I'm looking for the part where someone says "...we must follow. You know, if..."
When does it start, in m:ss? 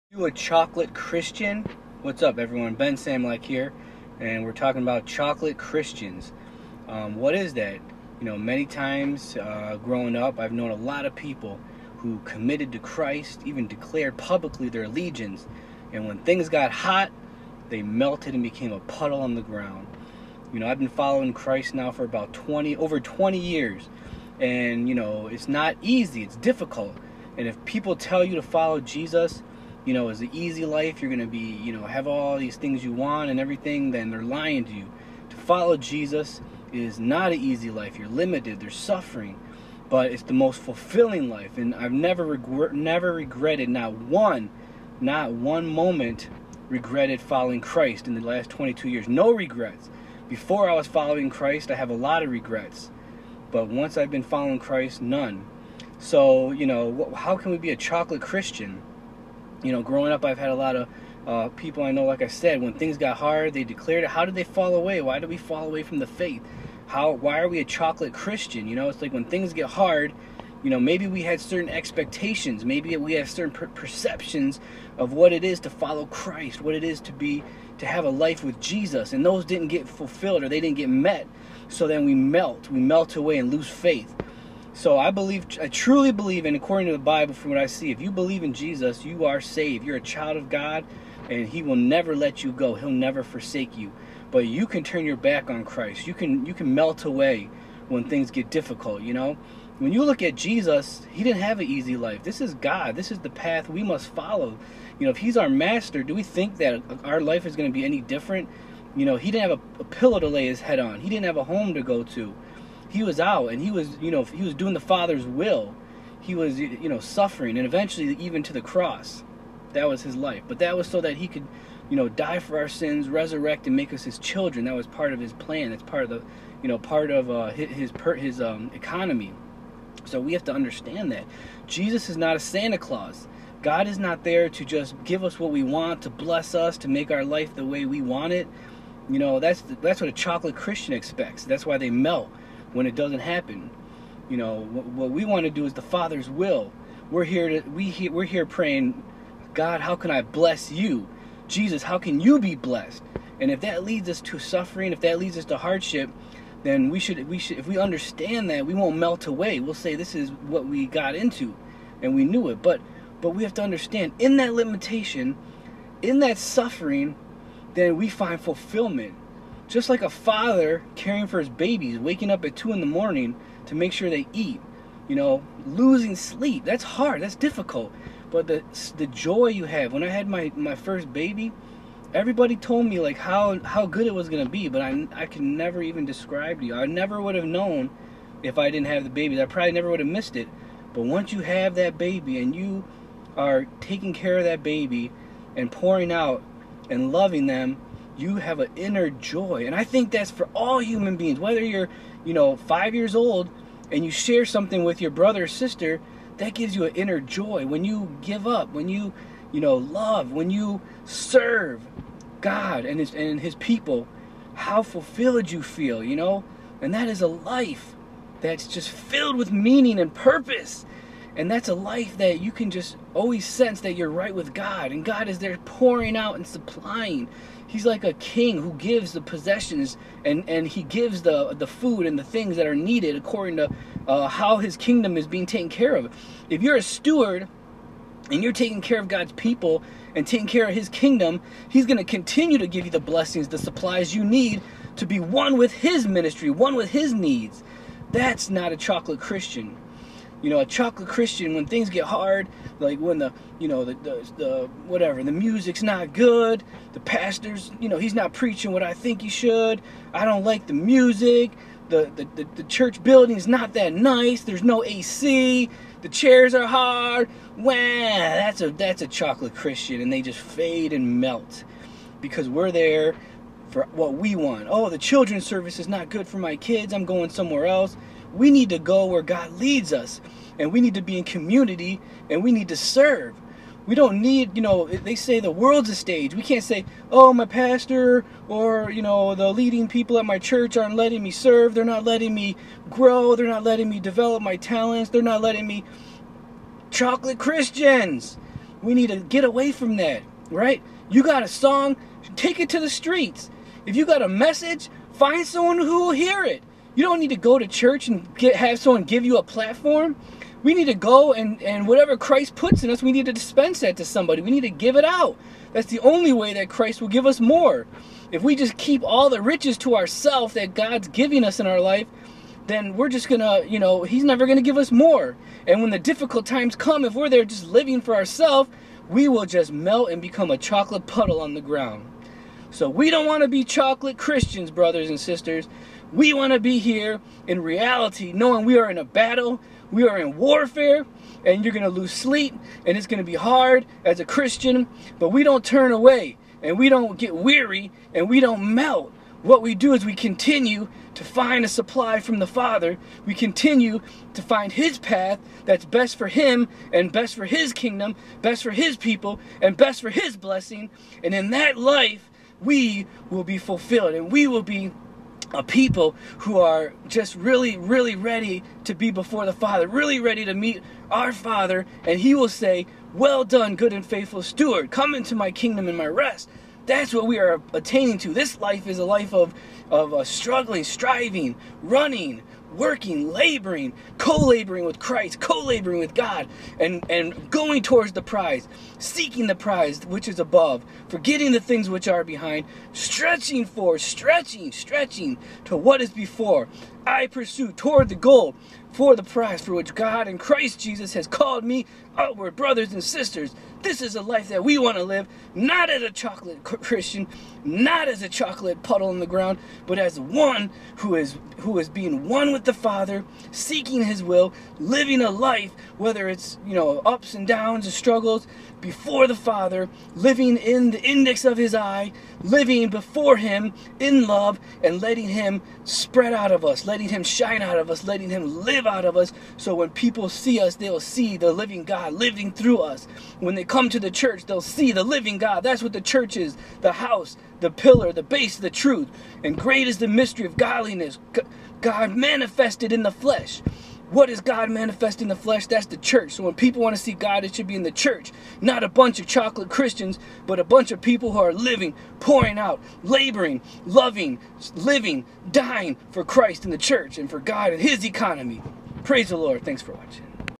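1:43.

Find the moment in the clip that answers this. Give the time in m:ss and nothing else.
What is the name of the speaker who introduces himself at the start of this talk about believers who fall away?
0:02.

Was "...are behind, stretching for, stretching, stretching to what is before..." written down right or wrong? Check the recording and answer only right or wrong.
right.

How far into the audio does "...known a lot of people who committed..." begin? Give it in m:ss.
0:10.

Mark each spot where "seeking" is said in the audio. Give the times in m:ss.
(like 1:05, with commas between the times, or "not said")
6:28, 6:53.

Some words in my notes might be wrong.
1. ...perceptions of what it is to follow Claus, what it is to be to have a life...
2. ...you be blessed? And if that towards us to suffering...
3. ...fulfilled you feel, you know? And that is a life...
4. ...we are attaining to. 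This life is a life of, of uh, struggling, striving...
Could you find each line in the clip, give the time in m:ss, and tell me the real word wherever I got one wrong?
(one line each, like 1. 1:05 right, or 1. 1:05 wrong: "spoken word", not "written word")
1. 1:13 wrong: "Christ", not "Claus"
2. 2:32 wrong: "leads", not "towards"
3. 3:34 right
4. 6:17 right.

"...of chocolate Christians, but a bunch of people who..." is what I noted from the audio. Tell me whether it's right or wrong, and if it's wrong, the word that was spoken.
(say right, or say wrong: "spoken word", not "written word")
right.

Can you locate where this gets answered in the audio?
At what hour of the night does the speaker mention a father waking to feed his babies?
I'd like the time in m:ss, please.
2:52.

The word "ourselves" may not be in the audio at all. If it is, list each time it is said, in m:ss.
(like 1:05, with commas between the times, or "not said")
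5:19, 5:28.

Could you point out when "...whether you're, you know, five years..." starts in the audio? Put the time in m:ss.
3:21.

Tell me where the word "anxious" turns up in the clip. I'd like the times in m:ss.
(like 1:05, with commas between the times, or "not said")
not said.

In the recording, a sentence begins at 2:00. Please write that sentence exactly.
But that was so that he could, you know, die for our sins, resurrect, and make us his children.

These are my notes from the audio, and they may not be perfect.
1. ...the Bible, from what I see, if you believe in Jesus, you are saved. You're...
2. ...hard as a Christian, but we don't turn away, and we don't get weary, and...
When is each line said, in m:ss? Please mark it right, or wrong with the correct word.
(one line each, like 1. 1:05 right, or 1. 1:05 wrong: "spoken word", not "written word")
1. 1:26 right
2. 5:43 right.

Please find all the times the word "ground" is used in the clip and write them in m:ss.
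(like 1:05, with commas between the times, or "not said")
0:19, 5:31, 6:49.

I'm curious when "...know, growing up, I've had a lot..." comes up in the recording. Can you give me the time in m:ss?
0:59.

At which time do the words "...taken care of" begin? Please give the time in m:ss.
3:55.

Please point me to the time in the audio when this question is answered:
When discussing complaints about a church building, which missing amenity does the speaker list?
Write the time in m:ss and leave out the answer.
4:24.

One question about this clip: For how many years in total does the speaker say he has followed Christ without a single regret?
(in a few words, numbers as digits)
22.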